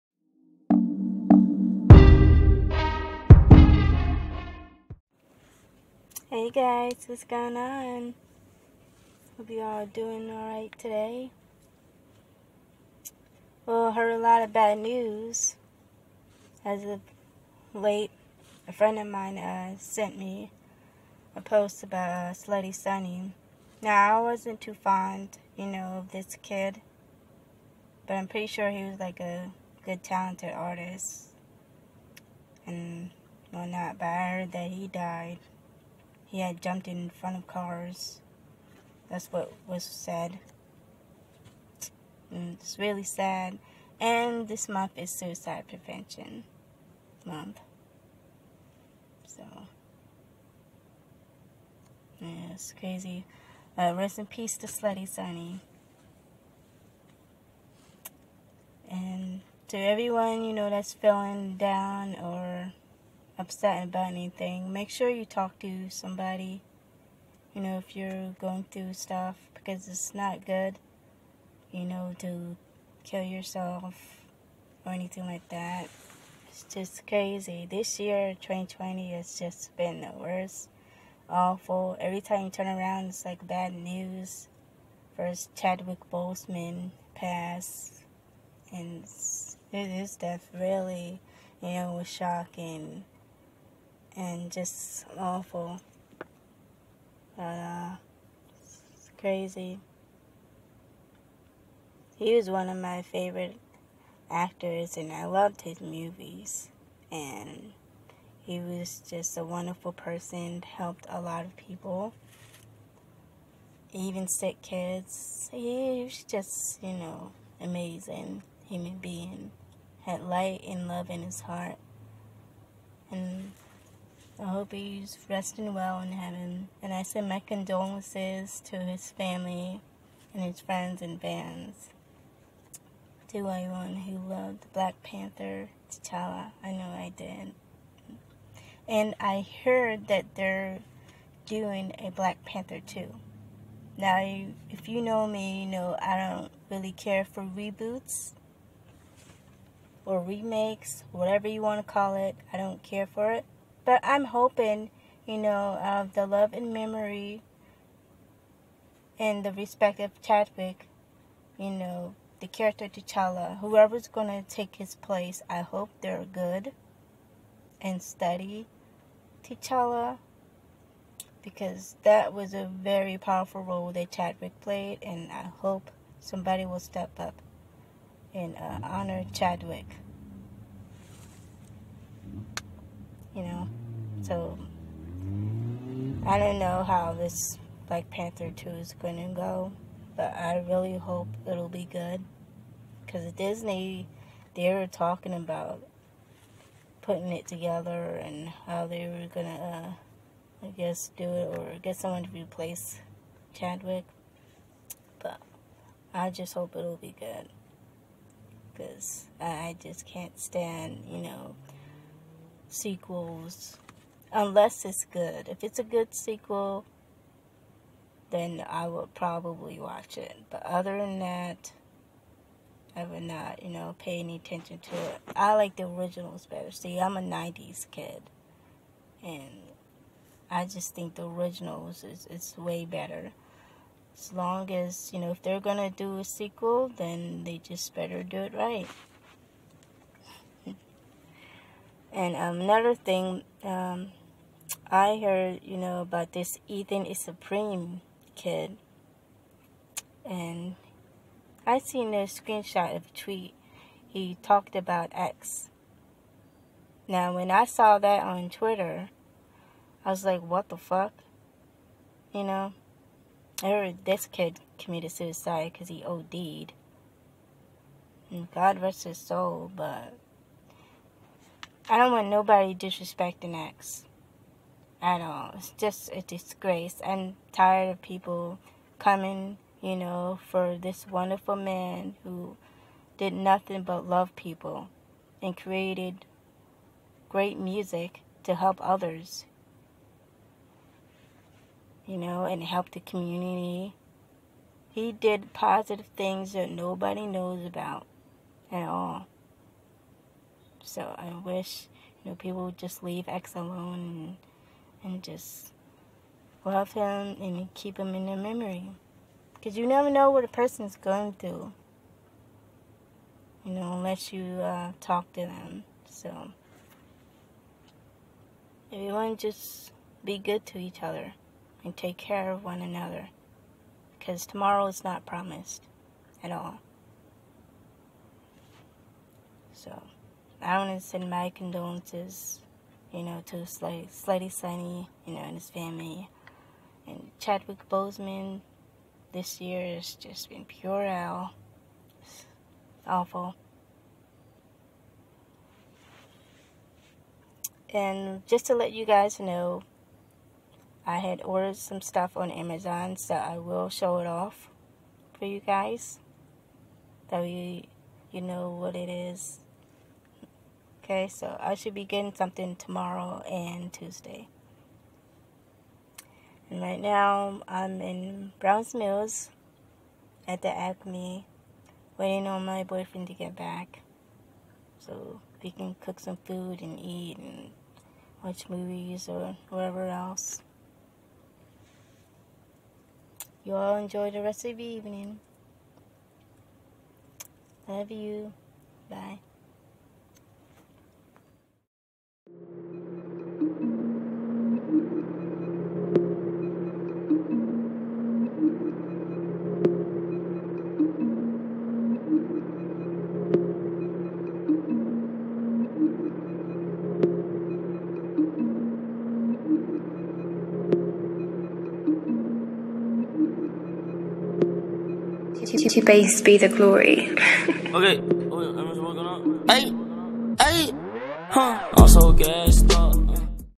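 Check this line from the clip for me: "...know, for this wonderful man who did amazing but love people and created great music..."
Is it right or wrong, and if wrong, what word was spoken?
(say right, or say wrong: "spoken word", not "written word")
wrong: "nothing", not "amazing".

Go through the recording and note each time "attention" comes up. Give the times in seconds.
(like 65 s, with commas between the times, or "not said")
224 s.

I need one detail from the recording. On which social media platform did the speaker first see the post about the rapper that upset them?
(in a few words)
Twitter.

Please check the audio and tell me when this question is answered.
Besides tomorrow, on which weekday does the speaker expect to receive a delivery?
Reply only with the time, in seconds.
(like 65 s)
363 s.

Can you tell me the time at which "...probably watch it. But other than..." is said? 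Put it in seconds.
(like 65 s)
219 s.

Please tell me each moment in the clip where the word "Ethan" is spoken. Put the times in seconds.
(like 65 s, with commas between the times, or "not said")
246 s.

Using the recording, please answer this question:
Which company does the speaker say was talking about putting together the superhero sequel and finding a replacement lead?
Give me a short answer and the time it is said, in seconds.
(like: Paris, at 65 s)
Disney, at 193 s.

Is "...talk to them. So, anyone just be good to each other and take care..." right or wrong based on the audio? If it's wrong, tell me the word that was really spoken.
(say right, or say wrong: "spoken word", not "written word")
wrong: "everyone", not "anyone".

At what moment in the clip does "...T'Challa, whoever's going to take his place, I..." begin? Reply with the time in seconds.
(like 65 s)
162 s.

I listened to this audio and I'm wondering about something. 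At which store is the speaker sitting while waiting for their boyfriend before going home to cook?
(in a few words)
Acme.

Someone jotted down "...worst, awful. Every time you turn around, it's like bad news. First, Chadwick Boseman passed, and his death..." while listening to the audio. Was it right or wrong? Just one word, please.
right.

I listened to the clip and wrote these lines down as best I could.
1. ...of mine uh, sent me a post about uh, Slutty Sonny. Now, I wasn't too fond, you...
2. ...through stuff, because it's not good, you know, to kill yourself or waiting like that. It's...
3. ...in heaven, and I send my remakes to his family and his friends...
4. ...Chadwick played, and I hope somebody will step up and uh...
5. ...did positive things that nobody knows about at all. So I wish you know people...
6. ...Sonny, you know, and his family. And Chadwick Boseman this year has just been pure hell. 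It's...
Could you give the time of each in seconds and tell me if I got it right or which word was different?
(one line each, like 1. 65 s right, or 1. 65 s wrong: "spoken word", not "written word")
1. 18 s right
2. 68 s wrong: "anything", not "waiting"
3. 126 s wrong: "condolences", not "remakes"
4. 174 s right
5. 295 s right
6. 334 s right.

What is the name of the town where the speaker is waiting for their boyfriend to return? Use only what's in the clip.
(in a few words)
Browns Mills.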